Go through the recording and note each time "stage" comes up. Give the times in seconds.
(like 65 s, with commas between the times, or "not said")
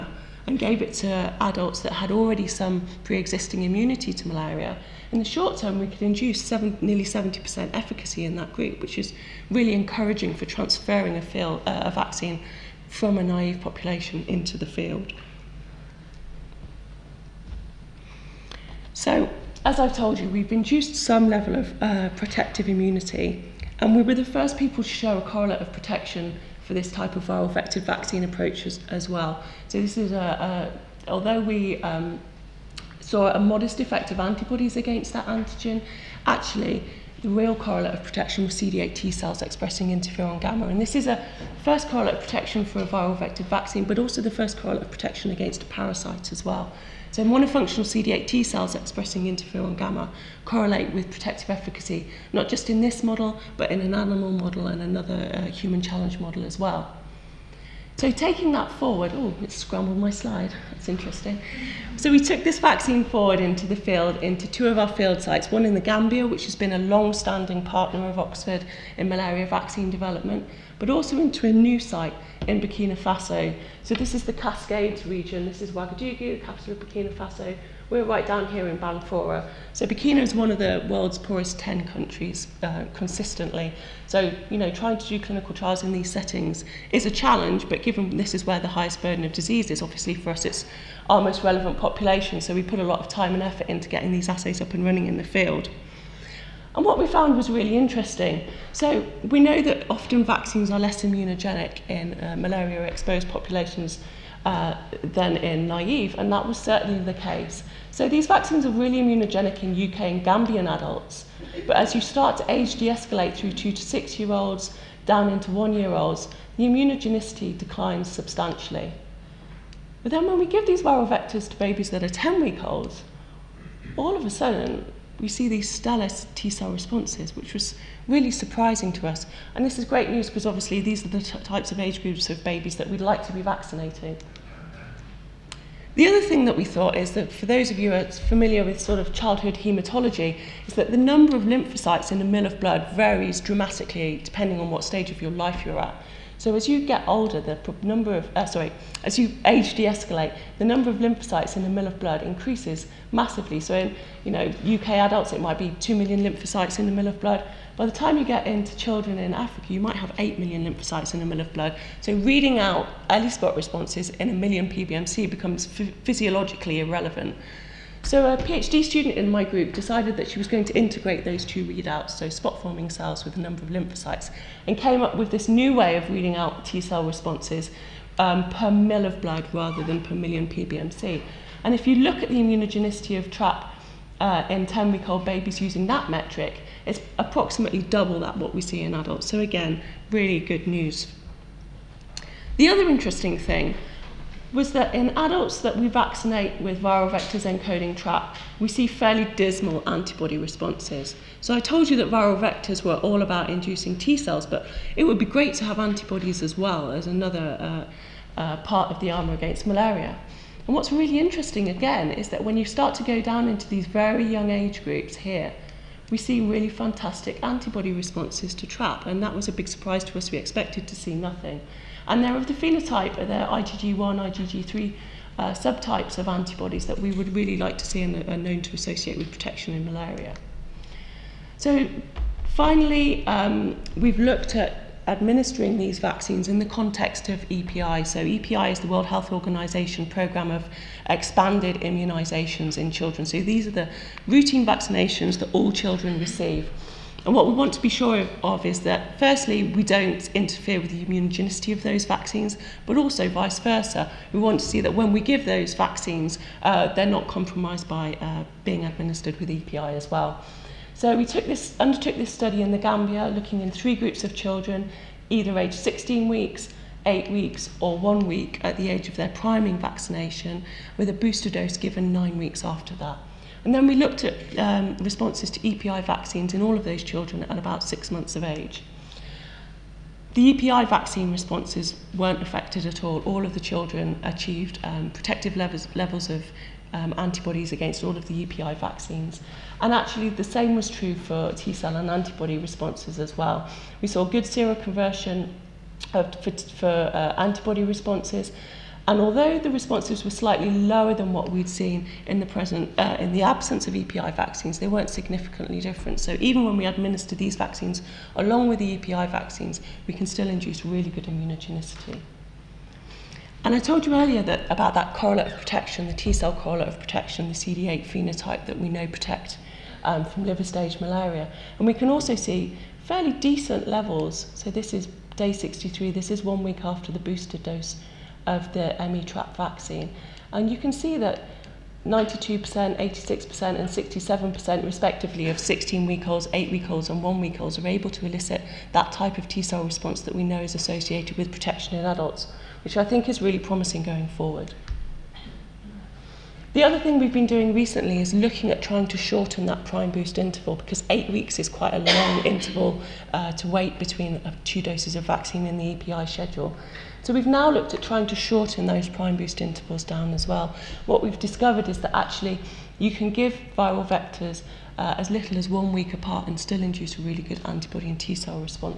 144 s, 320 s.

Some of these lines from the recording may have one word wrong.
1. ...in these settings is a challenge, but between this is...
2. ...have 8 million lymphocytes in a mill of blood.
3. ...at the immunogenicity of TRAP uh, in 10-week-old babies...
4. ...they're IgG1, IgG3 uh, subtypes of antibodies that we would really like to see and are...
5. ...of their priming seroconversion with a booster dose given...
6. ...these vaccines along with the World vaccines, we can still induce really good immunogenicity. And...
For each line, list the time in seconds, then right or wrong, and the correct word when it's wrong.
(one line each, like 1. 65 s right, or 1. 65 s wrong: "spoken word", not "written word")
1. 85 s wrong: "given", not "between"
2. 159 s right
3. 182 s right
4. 223 s right
5. 269 s wrong: "vaccination", not "seroconversion"
6. 307 s wrong: "EPI", not "World".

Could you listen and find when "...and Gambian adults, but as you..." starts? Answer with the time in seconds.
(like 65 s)
109 s.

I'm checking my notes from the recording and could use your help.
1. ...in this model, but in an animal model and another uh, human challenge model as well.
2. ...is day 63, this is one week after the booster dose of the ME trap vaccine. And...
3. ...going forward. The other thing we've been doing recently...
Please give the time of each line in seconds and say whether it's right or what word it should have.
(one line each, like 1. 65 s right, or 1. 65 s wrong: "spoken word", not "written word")
1. 52 s right
2. 324 s right
3. 344 s right.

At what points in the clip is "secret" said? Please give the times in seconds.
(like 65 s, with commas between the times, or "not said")
not said.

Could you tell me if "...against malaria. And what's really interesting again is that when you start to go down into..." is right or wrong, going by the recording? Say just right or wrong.
right.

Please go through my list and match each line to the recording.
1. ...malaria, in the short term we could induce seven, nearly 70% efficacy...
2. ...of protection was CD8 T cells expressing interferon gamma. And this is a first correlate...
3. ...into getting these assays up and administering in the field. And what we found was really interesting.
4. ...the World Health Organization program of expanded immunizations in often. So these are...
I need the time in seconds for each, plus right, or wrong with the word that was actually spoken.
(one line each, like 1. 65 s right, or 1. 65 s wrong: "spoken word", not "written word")
1. 4 s right
2. 37 s right
3. 93 s wrong: "running", not "administering"
4. 238 s wrong: "children", not "often".